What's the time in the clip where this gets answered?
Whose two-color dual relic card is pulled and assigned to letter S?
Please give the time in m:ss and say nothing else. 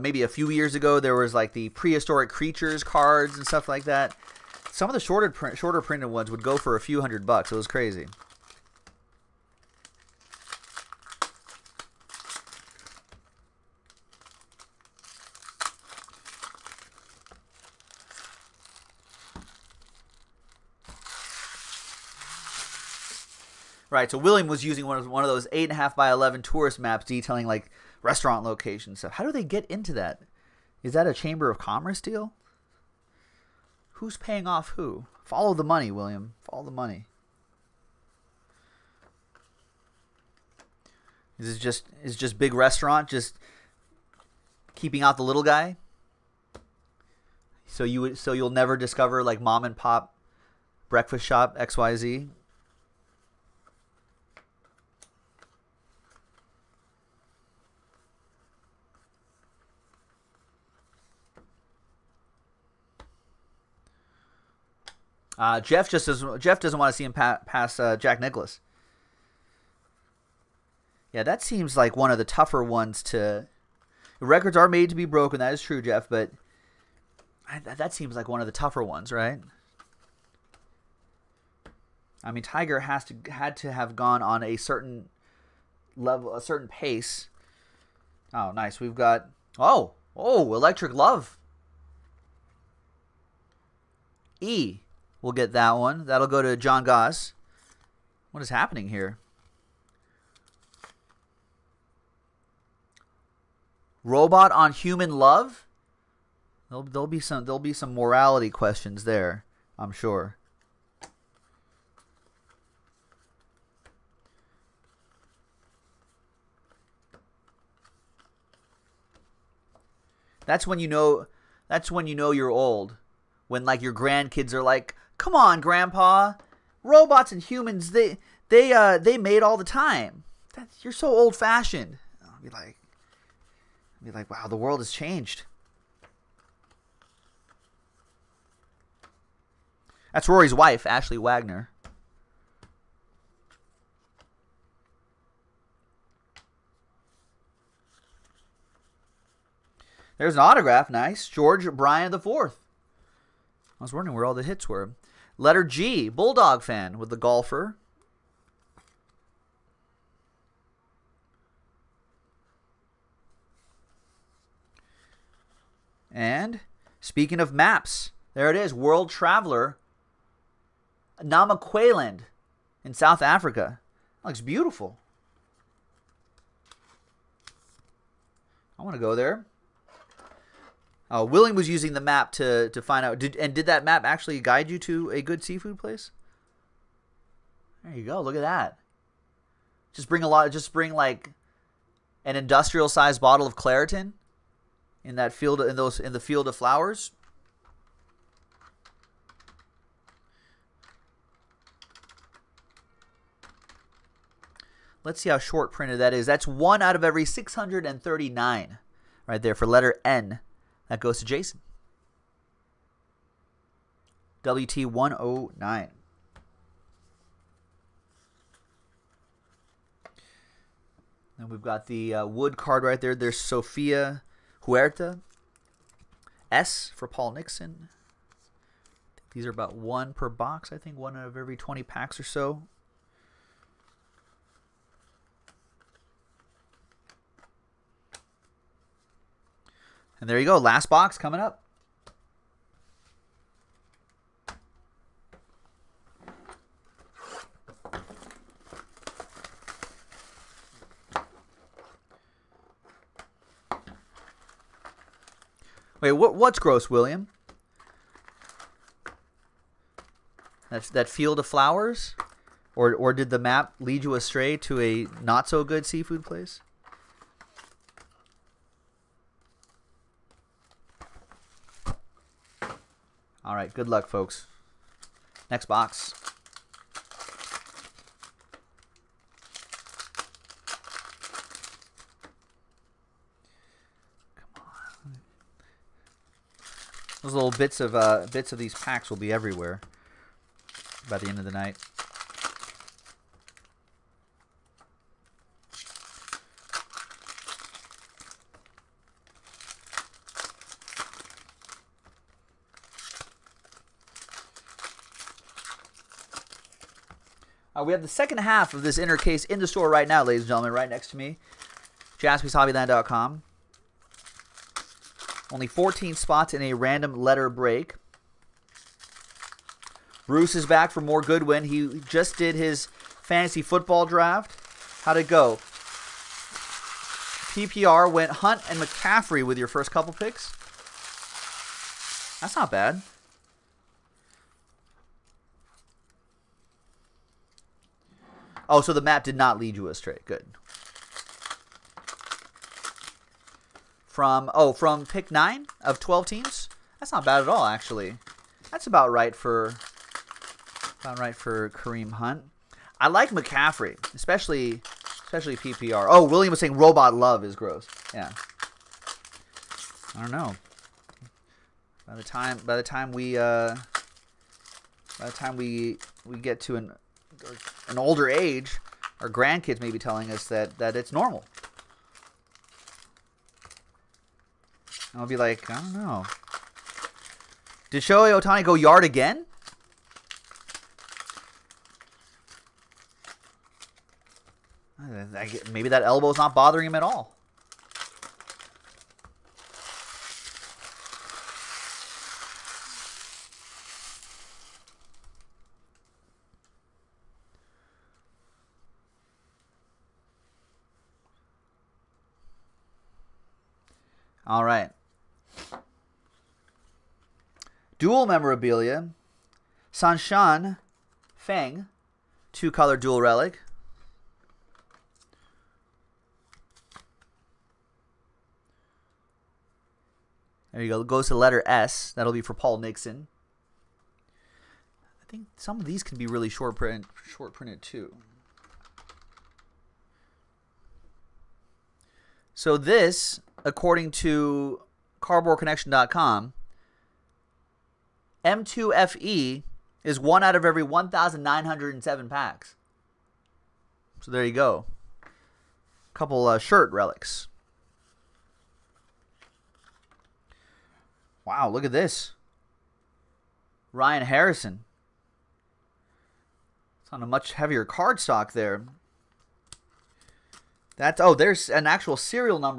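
6:49.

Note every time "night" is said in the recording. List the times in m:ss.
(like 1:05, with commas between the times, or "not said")
4:51.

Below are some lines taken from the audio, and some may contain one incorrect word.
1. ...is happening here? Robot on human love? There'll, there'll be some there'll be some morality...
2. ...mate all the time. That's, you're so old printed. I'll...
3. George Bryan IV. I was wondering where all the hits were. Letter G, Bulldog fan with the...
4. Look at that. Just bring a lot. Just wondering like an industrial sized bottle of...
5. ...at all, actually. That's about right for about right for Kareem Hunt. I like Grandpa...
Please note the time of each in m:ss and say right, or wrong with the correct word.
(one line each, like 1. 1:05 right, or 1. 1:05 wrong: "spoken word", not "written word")
1. 1:38 right
2. 2:09 wrong: "fashioned", not "printed"
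3. 2:31 right
4. 3:08 wrong: "bring", not "wondering"
5. 5:47 wrong: "McCaffrey", not "Grandpa".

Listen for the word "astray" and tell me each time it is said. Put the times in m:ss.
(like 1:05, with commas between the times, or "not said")
4:24, 5:39.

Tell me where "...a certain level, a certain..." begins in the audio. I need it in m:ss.
1:24.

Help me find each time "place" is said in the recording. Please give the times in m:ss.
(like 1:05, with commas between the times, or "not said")
3:05, 4:26.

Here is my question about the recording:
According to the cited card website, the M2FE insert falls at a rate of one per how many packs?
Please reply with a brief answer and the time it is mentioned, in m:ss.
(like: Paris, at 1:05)
1,907, at 7:20.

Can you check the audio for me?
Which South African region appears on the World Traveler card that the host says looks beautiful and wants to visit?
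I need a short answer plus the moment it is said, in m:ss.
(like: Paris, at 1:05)
Namaqualand, at 2:51.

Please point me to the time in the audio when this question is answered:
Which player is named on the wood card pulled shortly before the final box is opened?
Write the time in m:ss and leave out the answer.
3:43.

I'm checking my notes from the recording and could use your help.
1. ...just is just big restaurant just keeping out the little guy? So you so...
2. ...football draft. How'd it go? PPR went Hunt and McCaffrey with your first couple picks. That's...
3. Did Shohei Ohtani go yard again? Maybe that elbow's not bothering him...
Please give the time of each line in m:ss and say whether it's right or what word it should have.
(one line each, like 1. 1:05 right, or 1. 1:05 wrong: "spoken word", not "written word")
1. 0:41 right
2. 5:23 right
3. 6:17 right.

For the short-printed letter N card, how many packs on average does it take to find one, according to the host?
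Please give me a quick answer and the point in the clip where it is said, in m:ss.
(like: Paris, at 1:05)
639, at 3:27.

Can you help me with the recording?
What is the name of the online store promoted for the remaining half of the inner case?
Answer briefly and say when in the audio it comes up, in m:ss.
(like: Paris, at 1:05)
JaspysHobbyland.com, at 5:12.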